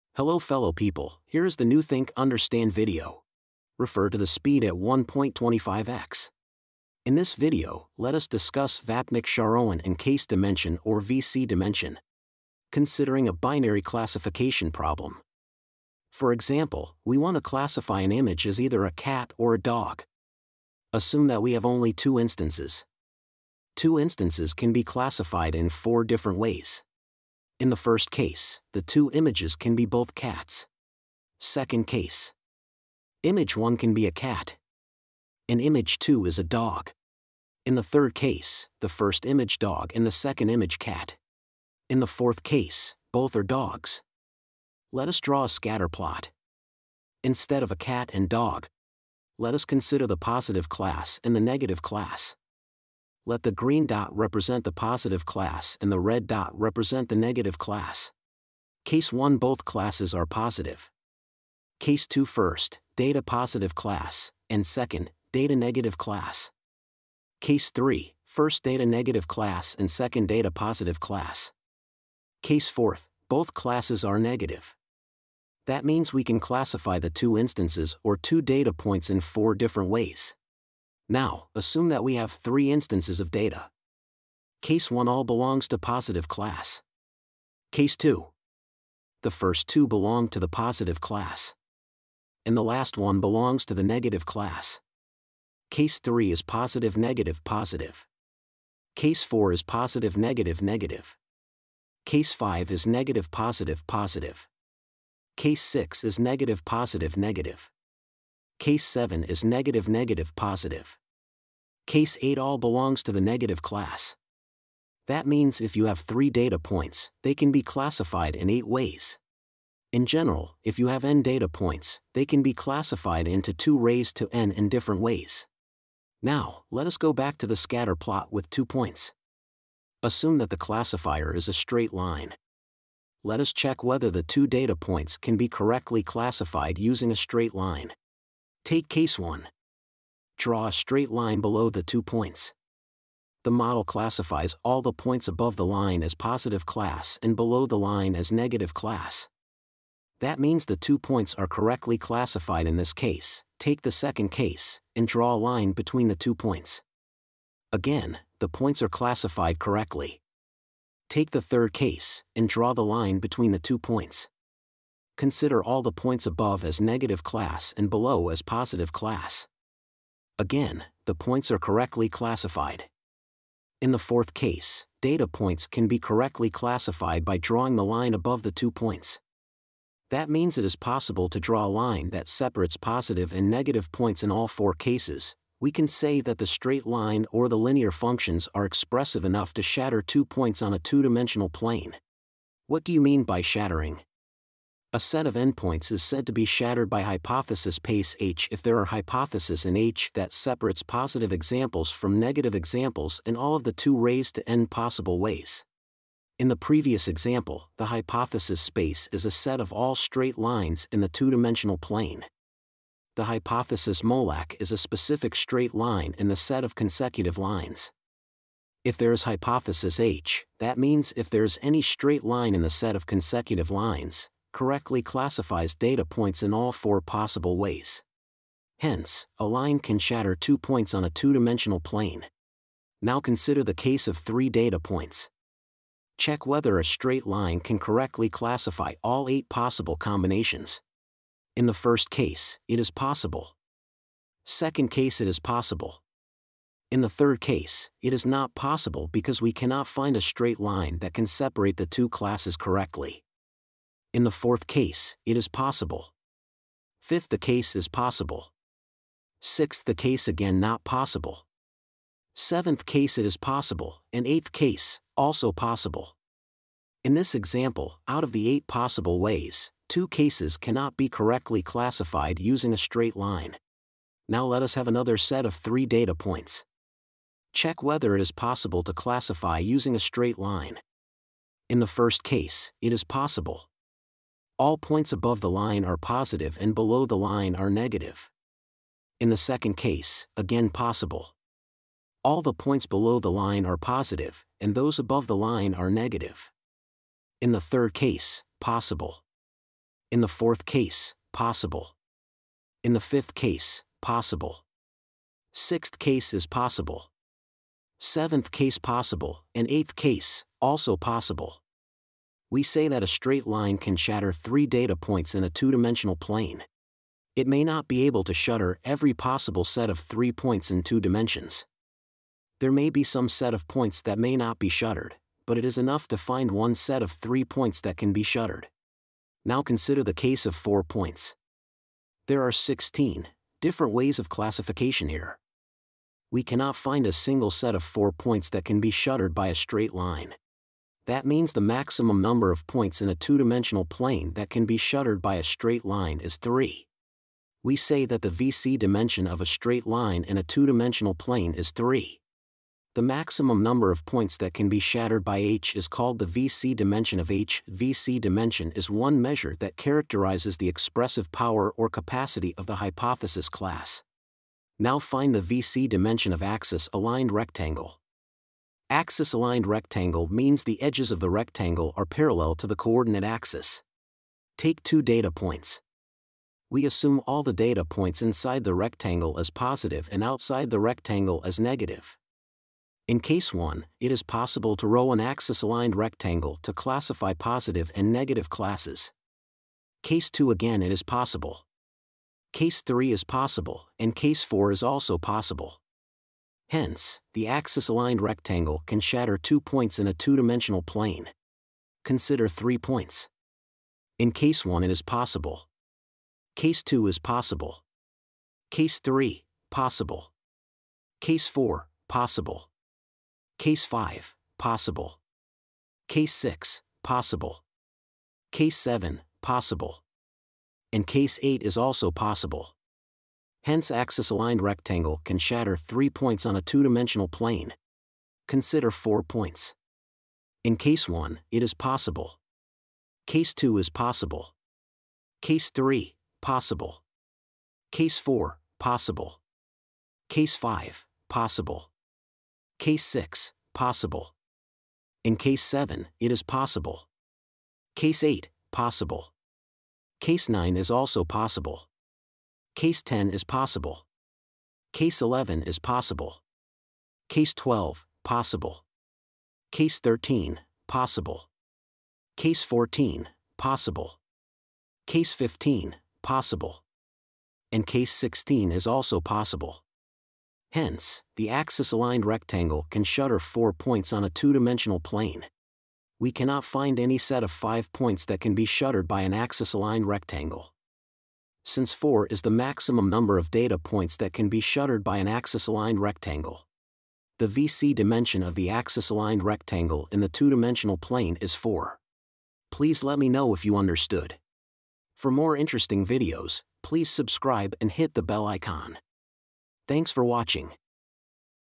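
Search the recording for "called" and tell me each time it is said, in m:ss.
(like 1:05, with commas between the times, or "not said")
5:55.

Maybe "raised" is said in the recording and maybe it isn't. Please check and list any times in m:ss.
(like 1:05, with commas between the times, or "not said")
2:03, 3:23.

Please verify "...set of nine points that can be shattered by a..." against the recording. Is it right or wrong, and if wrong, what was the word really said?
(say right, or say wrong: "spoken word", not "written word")
wrong: "four", not "nine".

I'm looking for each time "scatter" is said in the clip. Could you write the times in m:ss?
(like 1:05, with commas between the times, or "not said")
0:45, 2:07.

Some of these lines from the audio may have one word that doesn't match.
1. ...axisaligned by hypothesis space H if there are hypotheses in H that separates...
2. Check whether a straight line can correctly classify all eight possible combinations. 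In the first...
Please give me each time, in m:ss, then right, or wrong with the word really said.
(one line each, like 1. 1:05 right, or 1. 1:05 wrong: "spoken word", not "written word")
1. 3:16 wrong: "shattered", not "axisaligned"
2. 3:56 right.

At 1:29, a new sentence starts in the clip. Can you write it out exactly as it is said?
The first two belong to the positive class.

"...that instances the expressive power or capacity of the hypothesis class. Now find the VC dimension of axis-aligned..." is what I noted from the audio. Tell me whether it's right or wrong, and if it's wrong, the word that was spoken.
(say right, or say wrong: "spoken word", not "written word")
wrong: "characterizes", not "instances".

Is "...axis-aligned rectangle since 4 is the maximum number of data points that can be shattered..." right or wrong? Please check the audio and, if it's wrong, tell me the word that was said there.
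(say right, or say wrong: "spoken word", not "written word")
right.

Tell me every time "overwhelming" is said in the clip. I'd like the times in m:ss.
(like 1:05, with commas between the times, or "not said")
not said.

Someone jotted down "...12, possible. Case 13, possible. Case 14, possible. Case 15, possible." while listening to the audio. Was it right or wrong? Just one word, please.
right.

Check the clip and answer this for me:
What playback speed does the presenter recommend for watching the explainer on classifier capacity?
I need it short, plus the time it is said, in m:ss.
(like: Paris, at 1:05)
1.25x, at 0:04.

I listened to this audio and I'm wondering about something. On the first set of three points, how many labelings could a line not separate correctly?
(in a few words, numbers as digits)
2.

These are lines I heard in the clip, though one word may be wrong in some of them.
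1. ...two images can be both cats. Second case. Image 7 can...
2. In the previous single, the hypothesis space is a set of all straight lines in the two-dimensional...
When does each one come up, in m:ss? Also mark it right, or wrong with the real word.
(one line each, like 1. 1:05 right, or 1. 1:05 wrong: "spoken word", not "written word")
1. 0:28 wrong: "1", not "7"
2. 3:26 wrong: "example", not "single".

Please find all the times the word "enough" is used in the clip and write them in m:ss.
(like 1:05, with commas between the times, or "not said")
3:09, 5:25.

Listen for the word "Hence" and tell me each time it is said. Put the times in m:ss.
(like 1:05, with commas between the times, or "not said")
3:48, 6:36, 7:03, 7:50.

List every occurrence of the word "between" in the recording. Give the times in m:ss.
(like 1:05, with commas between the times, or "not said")
2:35, 2:43.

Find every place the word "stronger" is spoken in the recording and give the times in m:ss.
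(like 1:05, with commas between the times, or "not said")
not said.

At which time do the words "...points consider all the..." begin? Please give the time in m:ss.
2:43.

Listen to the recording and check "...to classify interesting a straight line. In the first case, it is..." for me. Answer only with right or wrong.
wrong.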